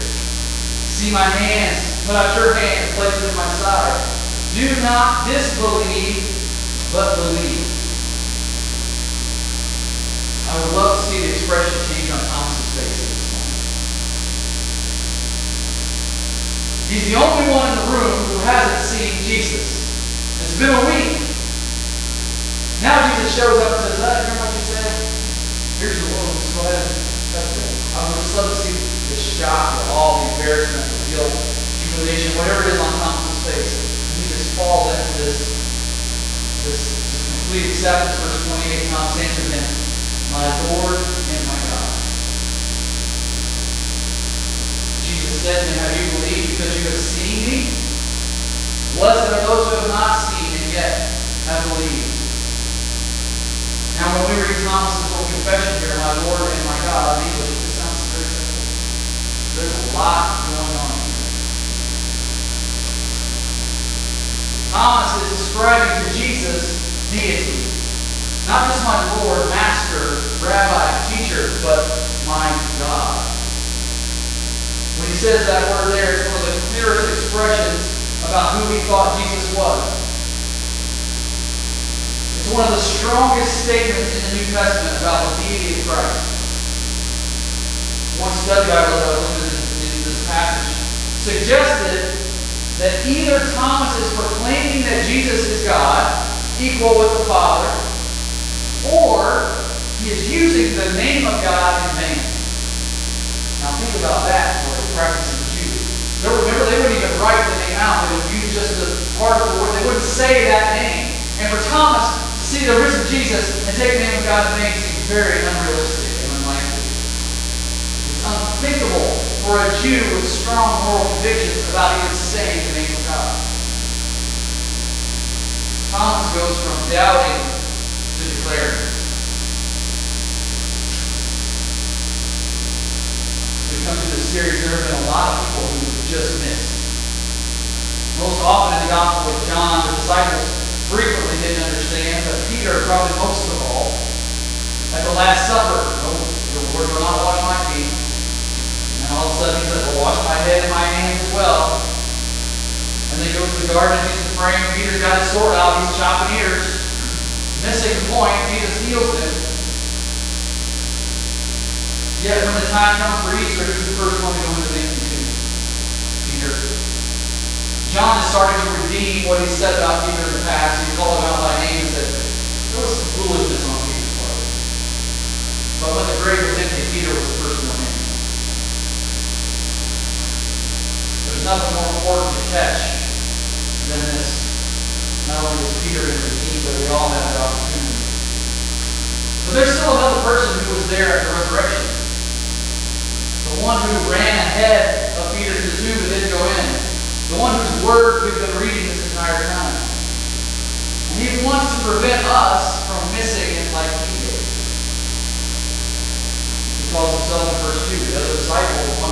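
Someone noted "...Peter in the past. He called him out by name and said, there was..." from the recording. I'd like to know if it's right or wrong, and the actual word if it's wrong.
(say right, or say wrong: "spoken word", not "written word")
right.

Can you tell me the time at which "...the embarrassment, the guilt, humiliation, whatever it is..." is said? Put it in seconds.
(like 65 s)
30 s.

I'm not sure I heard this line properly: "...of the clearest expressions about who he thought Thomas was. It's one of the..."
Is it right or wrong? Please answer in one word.
wrong.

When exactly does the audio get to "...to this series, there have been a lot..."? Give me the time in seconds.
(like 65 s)
134 s.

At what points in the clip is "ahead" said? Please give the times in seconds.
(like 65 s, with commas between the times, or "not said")
26 s, 194 s.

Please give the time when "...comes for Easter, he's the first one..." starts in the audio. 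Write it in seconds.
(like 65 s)
163 s.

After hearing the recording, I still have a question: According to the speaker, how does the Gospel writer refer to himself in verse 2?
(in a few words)
The other disciple.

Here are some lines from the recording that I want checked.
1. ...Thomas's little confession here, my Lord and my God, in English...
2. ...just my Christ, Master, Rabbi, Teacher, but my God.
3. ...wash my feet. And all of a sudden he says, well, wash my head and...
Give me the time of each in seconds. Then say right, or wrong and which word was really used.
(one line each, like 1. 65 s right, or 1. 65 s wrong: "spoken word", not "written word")
1. 54 s right
2. 68 s wrong: "Lord", not "Christ"
3. 147 s right.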